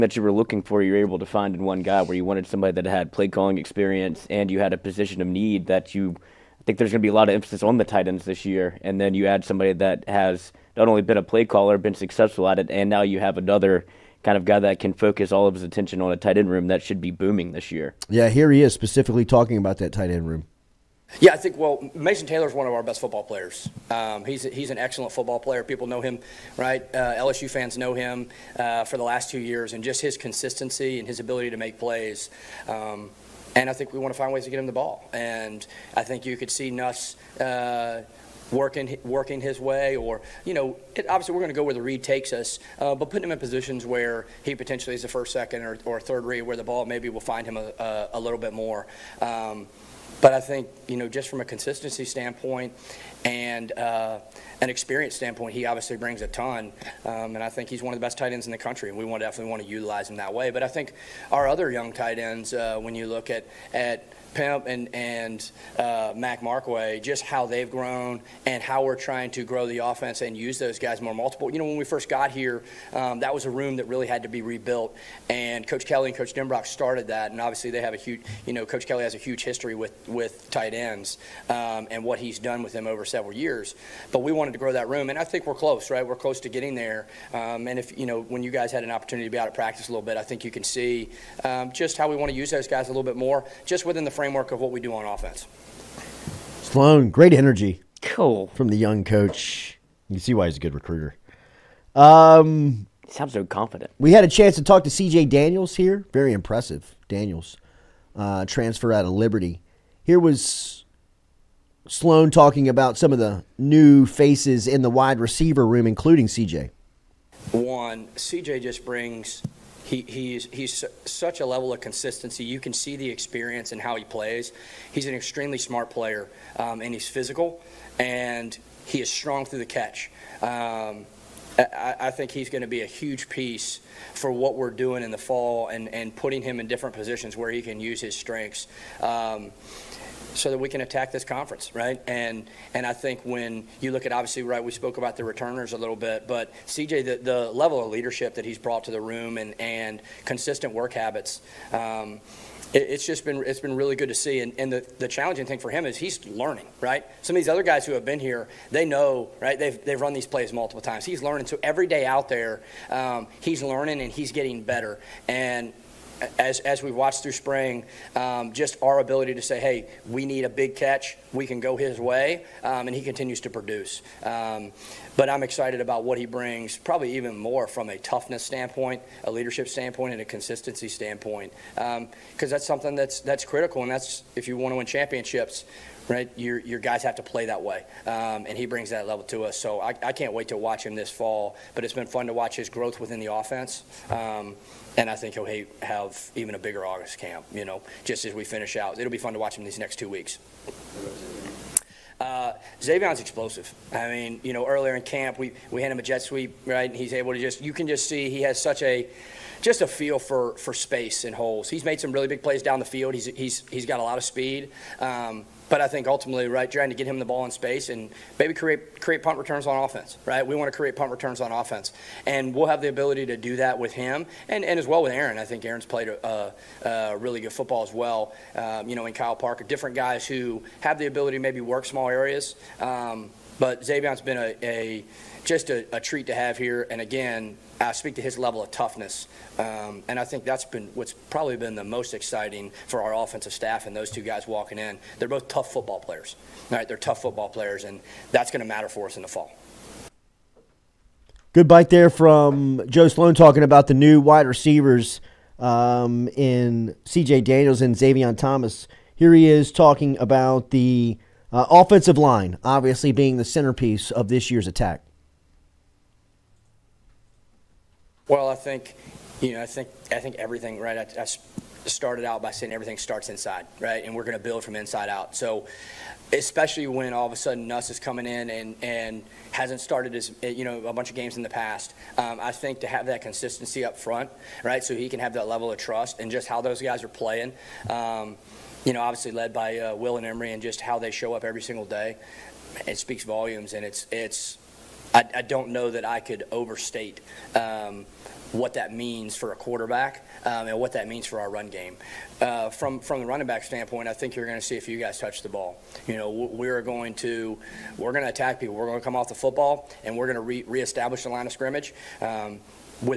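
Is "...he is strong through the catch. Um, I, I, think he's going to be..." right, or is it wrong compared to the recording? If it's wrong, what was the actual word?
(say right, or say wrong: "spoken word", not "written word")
right.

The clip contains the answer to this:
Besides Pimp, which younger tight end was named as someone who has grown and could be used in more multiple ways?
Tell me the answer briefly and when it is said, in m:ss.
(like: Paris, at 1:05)
Mac Markway, at 1:06.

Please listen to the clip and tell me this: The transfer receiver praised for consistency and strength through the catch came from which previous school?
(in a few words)
Liberty.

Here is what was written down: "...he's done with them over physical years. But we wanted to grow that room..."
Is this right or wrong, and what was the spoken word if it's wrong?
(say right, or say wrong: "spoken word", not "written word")
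wrong: "several", not "physical".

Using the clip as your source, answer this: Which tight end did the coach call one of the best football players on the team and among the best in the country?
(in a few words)
Mason Taylor.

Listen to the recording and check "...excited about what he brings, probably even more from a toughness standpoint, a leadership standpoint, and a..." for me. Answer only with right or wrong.
right.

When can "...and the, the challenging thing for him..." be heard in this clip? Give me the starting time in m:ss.
2:34.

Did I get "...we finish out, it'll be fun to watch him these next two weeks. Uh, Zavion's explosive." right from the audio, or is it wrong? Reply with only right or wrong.
right.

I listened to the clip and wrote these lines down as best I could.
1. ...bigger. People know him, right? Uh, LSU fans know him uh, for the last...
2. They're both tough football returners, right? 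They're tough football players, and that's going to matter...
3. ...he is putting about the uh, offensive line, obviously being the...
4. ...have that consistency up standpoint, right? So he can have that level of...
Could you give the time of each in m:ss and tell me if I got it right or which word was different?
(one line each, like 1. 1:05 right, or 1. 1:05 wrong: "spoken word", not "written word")
1. 0:25 wrong: "player", not "bigger"
2. 4:05 wrong: "players", not "returners"
3. 4:19 wrong: "talking", not "putting"
4. 4:42 wrong: "front", not "standpoint".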